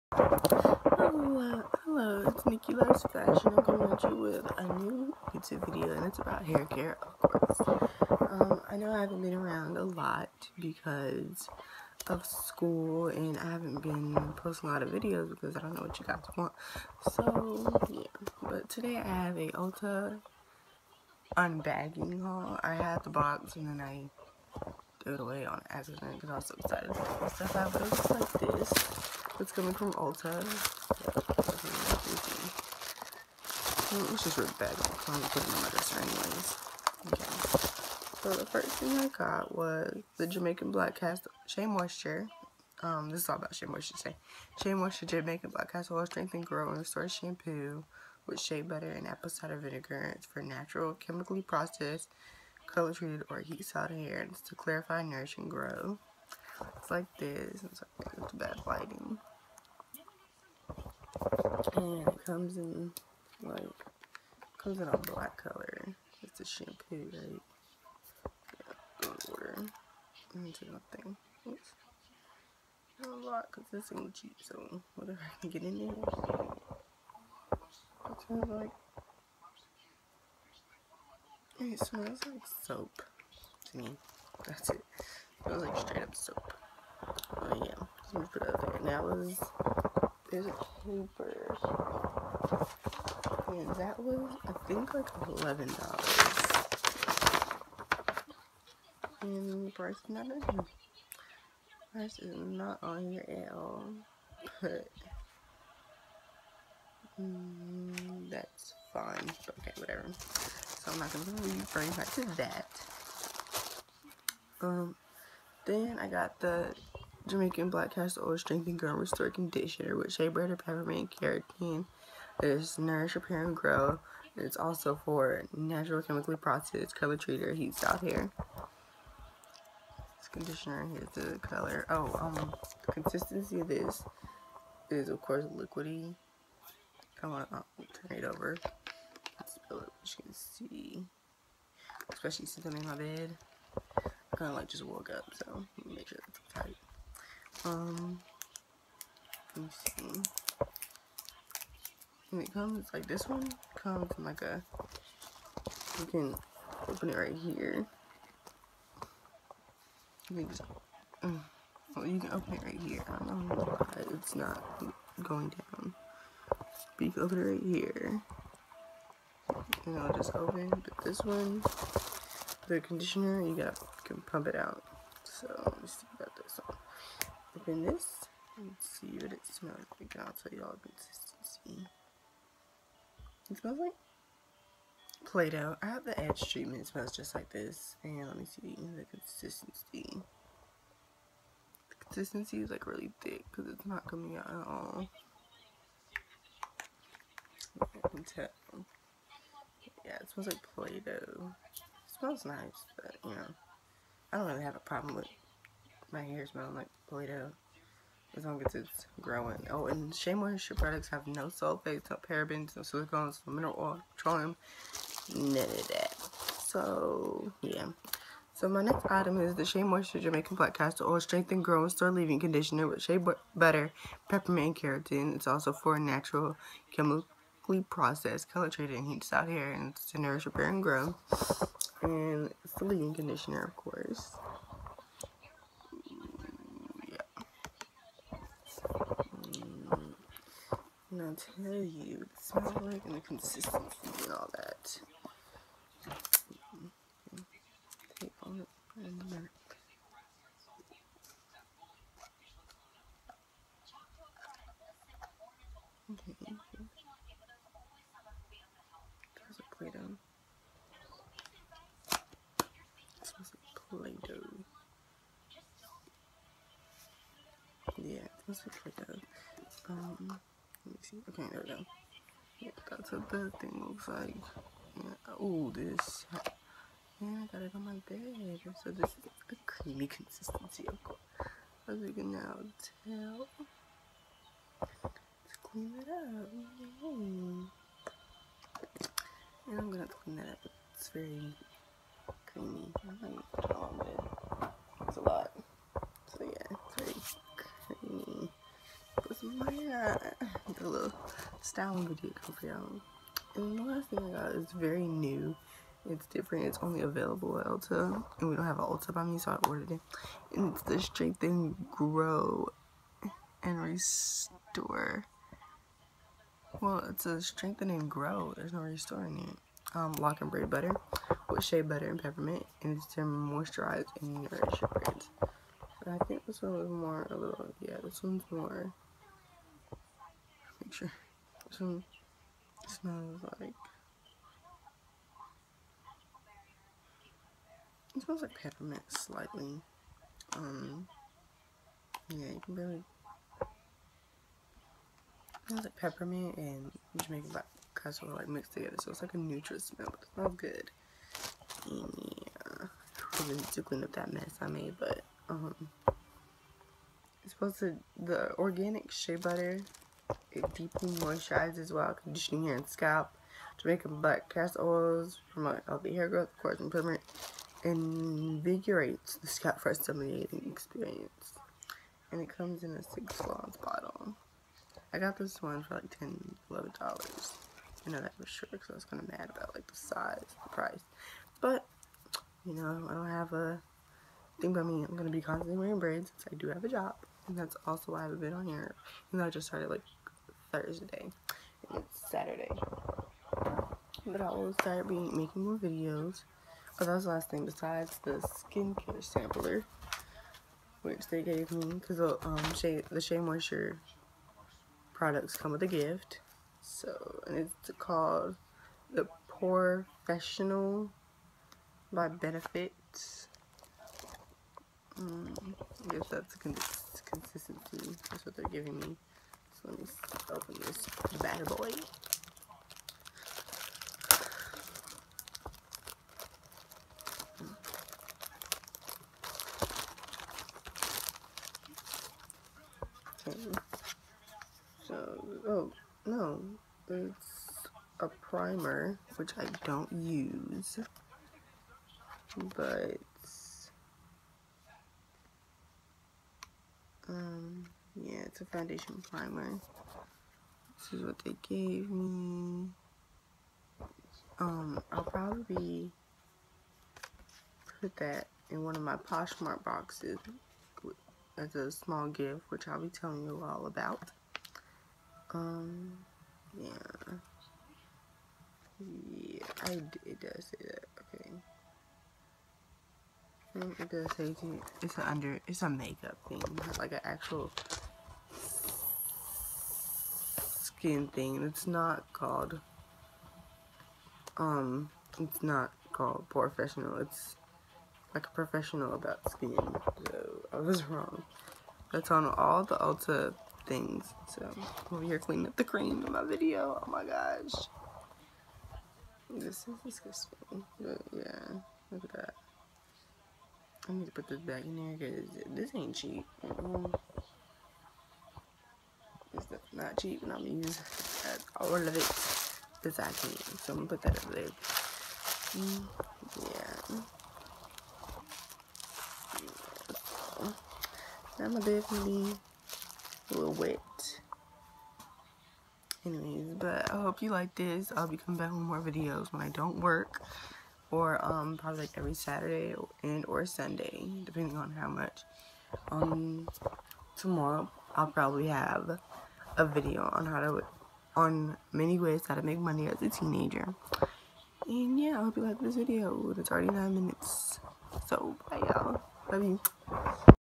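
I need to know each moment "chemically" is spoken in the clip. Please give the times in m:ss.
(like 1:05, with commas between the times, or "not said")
0:50, 2:06, 3:46.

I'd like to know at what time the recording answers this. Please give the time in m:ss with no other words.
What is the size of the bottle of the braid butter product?
6:13.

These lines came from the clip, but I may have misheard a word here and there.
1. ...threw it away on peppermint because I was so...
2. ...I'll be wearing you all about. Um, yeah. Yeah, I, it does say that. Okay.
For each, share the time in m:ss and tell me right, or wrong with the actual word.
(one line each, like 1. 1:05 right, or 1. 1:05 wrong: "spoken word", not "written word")
1. 0:25 wrong: "accident", not "peppermint"
2. 7:42 wrong: "telling", not "wearing".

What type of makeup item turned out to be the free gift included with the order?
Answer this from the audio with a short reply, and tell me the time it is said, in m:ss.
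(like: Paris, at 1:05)
Foundation primer, at 7:28.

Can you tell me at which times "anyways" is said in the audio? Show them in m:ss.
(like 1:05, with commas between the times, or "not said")
0:37, 8:46.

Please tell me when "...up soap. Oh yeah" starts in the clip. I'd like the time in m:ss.
1:26.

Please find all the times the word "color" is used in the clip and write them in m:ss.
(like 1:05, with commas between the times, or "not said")
0:52, 1:05, 2:06, 2:11, 3:48.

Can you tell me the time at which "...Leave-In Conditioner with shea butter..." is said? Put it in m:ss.
3:42.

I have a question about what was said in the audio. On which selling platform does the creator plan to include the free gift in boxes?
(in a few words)
Poshmark.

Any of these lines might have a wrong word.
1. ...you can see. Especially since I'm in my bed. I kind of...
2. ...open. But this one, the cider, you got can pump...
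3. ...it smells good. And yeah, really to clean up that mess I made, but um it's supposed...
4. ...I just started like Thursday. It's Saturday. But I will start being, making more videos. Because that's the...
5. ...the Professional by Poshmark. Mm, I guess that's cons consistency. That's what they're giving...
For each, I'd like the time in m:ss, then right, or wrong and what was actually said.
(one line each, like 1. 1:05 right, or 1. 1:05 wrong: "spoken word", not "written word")
1. 2:20 right
2. 2:50 wrong: "conditioner", not "cider"
3. 5:50 right
4. 6:29 right
5. 6:49 wrong: "Benefits", not "Poshmark".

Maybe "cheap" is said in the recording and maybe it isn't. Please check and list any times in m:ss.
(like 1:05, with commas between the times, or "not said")
1:14, 8:26, 8:30.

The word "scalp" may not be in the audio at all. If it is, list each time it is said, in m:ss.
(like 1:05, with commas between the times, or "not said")
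6:02, 6:09.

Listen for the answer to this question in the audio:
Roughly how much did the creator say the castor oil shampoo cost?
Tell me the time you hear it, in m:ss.
1:35.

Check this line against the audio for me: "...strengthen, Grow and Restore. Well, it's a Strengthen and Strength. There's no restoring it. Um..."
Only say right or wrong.
wrong.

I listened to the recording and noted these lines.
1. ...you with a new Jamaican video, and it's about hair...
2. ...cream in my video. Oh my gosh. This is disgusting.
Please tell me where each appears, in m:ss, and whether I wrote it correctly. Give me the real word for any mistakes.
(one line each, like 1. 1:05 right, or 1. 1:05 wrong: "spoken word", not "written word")
1. 0:04 wrong: "YouTube", not "Jamaican"
2. 8:15 right.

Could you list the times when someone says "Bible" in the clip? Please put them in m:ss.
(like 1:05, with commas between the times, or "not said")
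not said.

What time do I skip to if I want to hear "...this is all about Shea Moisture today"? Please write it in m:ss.
0:43.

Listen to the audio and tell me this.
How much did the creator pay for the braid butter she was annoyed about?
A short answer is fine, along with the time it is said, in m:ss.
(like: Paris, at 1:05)
$10, at 6:16.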